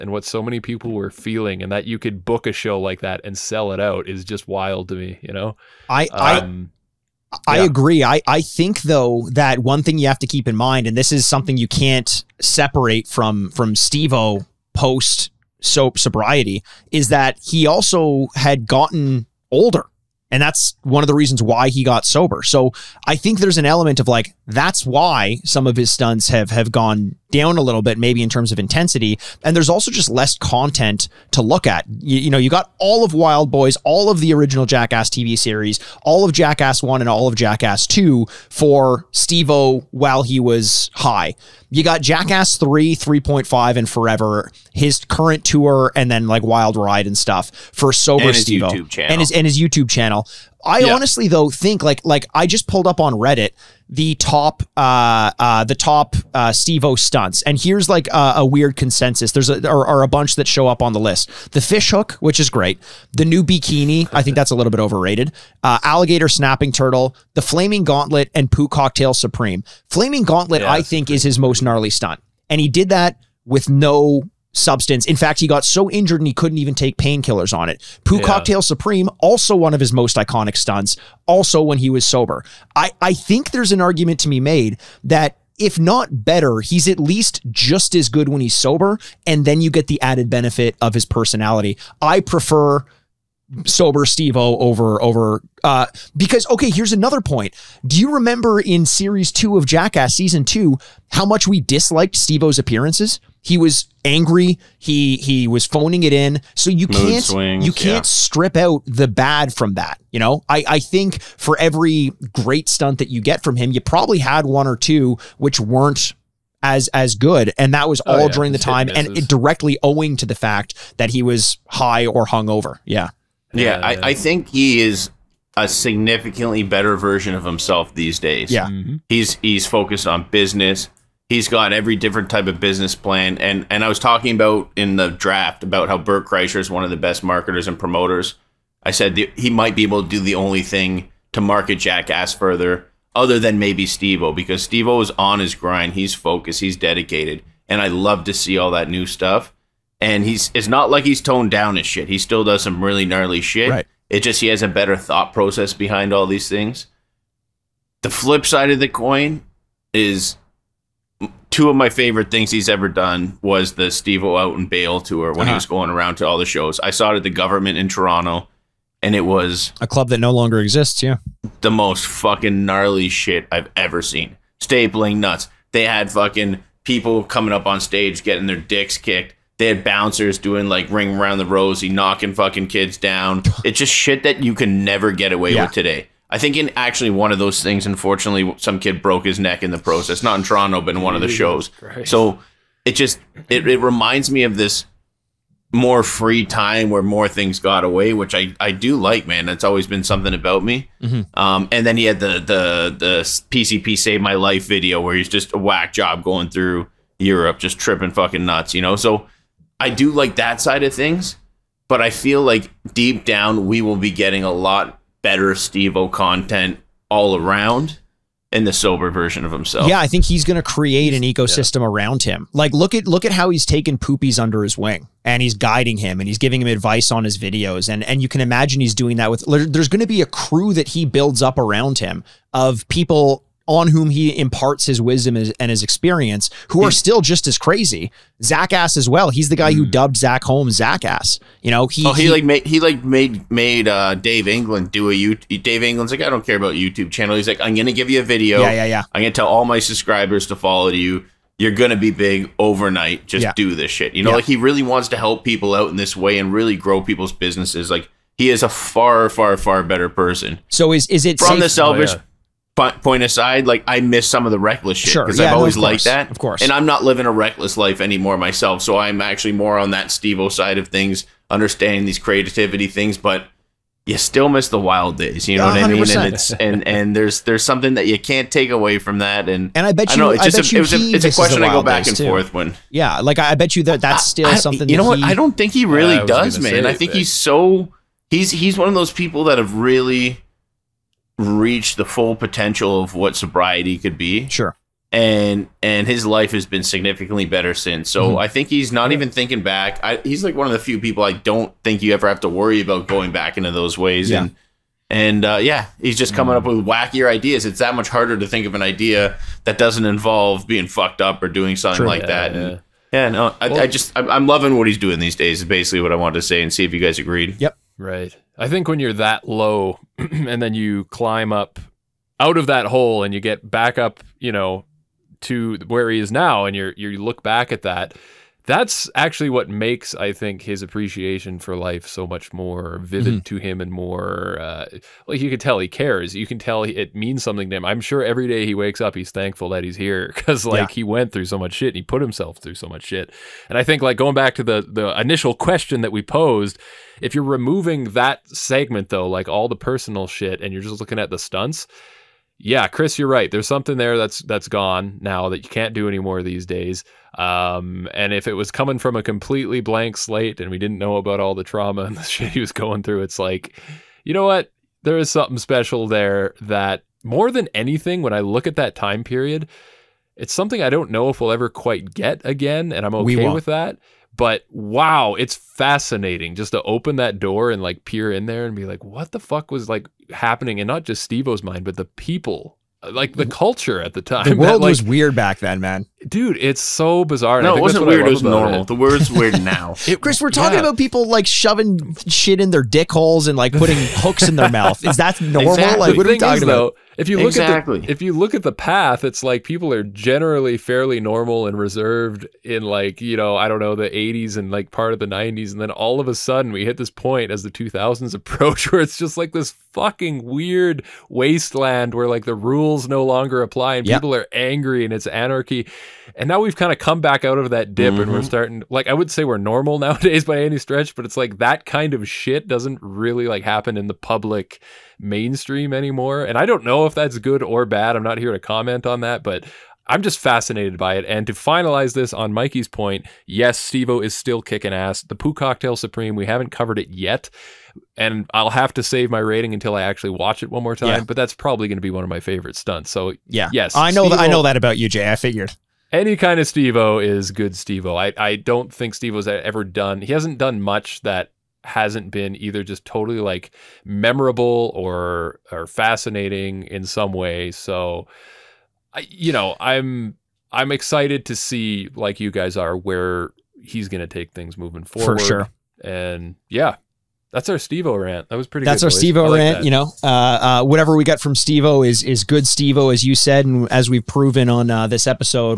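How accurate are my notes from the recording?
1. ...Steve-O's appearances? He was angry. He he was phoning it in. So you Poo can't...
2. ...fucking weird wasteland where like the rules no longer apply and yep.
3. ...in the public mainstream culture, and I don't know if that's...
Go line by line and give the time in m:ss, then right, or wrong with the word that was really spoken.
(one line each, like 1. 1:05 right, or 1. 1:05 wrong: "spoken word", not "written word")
1. 1:42 wrong: "Mood", not "Poo"
2. 6:49 right
3. 7:03 wrong: "anymore", not "culture".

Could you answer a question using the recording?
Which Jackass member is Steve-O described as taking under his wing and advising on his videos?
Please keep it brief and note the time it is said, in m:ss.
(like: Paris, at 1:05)
Poopies, at 3:43.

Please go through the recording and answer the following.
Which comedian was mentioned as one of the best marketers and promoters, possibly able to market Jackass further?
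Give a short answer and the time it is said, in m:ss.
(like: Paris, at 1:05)
Bert Kreischer, at 2:15.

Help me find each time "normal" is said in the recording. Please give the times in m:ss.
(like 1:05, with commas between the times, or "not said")
6:28, 6:35, 6:41, 6:59.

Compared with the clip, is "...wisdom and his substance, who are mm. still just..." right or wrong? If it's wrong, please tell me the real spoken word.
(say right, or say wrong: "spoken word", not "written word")
wrong: "experience", not "substance".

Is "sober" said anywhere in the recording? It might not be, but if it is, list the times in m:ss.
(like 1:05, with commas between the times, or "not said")
0:22, 0:47, 1:22, 1:28, 1:33, 3:38.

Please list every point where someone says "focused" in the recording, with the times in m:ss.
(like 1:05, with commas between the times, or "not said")
2:09, 2:26.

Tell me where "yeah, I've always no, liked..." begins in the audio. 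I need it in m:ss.
4:25.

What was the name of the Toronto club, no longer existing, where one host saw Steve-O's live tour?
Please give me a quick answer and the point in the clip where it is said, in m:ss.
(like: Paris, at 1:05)
The Guvernment, at 2:47.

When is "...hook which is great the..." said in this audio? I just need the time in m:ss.
1:01.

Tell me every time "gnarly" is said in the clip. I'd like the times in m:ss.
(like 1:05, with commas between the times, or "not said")
1:11, 2:33, 2:52.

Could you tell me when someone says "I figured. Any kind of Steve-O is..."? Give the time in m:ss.
7:25.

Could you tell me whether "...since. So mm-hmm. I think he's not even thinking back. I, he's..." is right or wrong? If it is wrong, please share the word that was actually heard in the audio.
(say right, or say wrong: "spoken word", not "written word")
right.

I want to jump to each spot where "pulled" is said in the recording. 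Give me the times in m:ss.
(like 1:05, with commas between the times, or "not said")
0:52.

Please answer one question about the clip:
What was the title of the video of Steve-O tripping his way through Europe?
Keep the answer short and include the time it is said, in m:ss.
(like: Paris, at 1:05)
PCP Save My Life, at 3:23.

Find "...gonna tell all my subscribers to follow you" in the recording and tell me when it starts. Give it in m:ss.
4:09.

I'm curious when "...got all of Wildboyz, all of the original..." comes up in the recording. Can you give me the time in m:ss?
0:32.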